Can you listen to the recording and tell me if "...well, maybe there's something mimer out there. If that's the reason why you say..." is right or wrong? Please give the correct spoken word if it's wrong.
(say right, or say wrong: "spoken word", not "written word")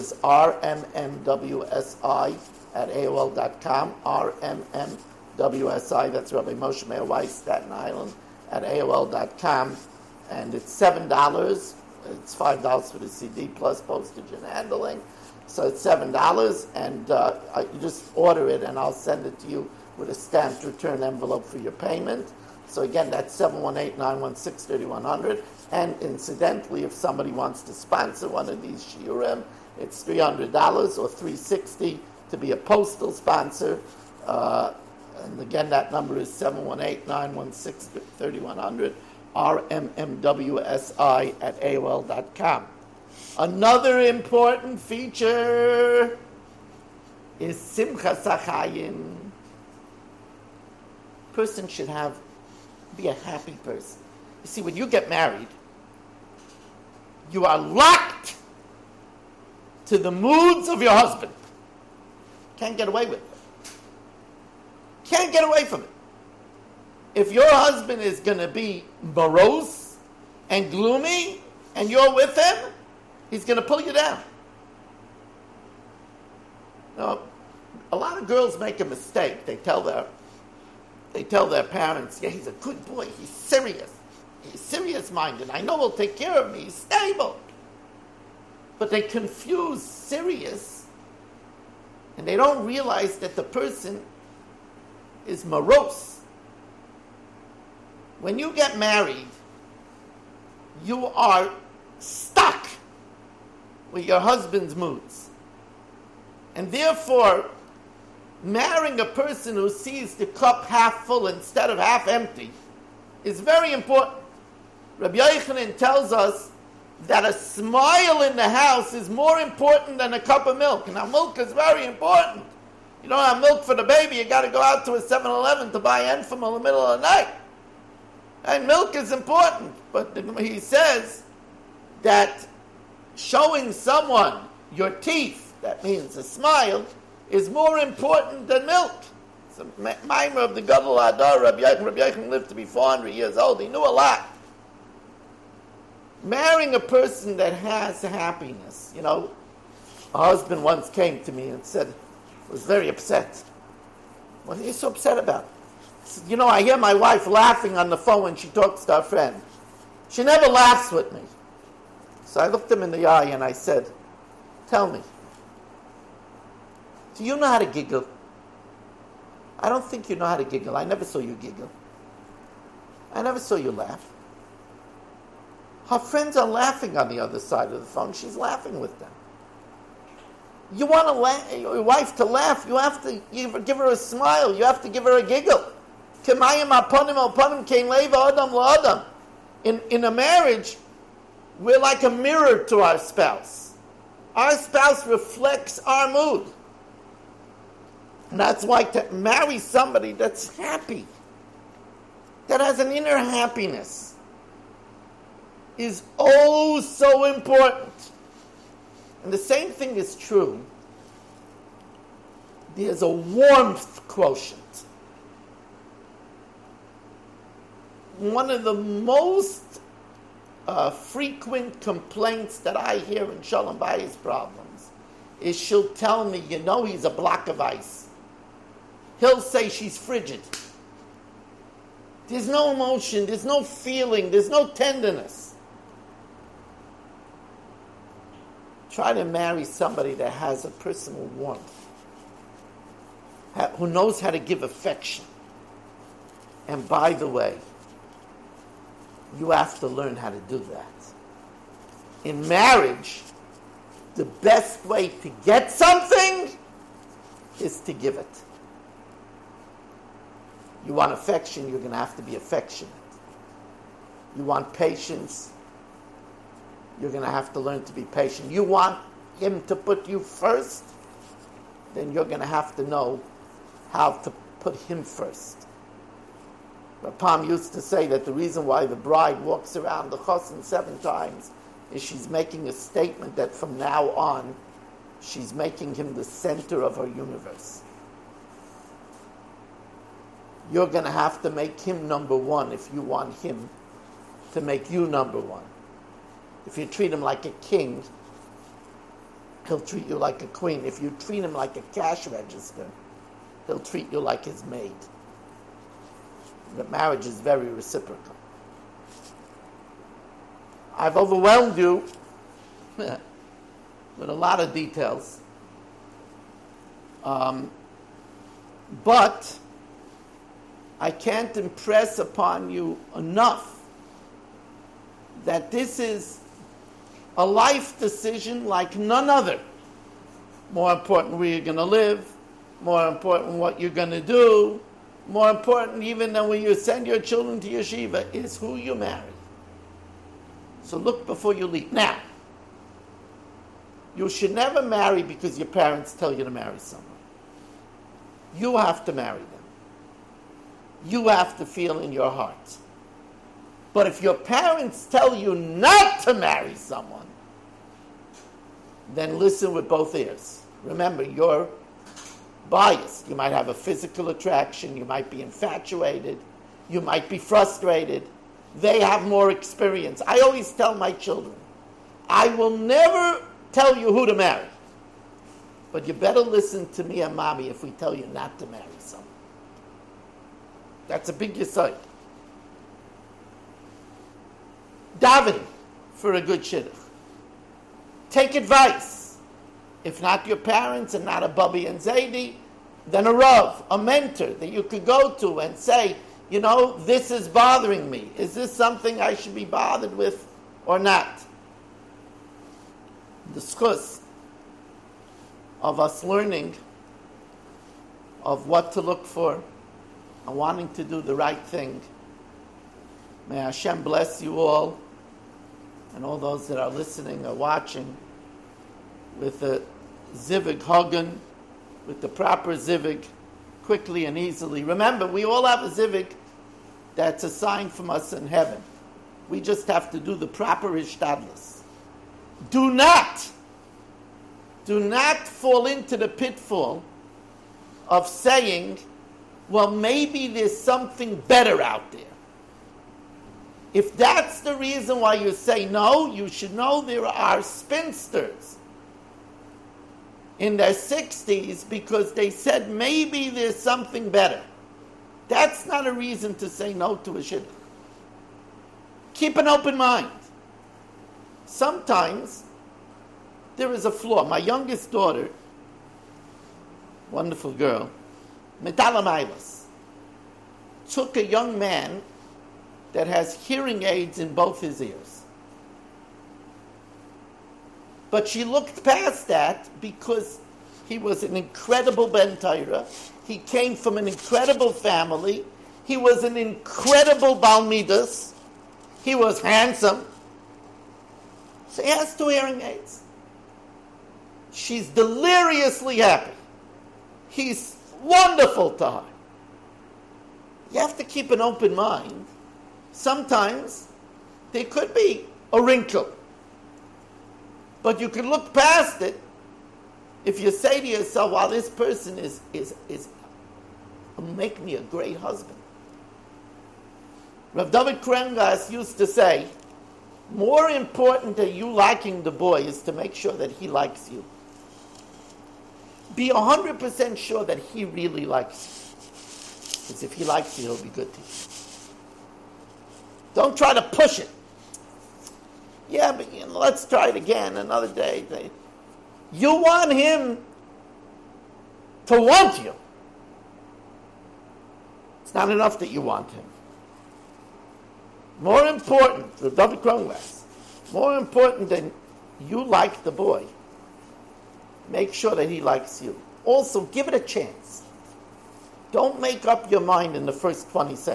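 wrong: "better", not "mimer".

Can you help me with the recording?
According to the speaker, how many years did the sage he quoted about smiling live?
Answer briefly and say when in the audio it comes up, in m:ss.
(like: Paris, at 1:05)
400, at 2:22.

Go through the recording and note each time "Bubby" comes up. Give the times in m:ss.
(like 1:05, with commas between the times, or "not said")
6:31.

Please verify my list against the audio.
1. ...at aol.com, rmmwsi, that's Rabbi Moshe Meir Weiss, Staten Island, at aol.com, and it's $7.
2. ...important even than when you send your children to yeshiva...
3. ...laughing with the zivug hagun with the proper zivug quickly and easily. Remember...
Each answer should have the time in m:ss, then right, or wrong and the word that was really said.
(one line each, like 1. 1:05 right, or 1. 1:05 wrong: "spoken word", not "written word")
1. 0:02 right
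2. 5:35 right
3. 6:57 wrong: "watching", not "laughing".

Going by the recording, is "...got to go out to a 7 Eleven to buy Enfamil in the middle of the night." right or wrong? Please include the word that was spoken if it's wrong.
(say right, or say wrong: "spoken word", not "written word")
right.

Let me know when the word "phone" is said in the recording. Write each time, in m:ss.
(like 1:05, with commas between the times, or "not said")
2:37, 2:57.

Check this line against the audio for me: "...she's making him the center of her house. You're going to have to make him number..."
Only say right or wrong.
wrong.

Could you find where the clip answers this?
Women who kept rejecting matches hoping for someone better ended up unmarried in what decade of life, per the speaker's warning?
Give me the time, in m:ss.
7:30.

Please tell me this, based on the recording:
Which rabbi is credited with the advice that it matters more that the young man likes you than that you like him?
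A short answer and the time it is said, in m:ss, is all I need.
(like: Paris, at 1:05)
Rav David Kronglas, at 8:37.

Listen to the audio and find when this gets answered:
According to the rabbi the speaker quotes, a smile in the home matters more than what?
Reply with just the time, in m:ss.
2:00.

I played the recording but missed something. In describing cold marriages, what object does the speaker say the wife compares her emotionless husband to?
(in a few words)
a block of ice.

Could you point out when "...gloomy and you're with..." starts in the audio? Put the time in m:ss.
1:10.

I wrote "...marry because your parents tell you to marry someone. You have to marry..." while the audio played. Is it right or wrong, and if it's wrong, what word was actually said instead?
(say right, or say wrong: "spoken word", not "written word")
right.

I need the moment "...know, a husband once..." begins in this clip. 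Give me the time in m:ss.
2:29.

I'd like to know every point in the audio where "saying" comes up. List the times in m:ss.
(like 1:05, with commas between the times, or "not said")
7:18.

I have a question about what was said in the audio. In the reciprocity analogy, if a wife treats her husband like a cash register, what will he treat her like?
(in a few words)
his maid.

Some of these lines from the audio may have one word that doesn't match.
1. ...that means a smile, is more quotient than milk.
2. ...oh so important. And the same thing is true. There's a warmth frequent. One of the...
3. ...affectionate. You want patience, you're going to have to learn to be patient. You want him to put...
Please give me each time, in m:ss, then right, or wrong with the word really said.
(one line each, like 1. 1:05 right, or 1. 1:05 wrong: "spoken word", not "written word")
1. 2:15 wrong: "important", not "quotient"
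2. 3:26 wrong: "quotient", not "frequent"
3. 4:22 right.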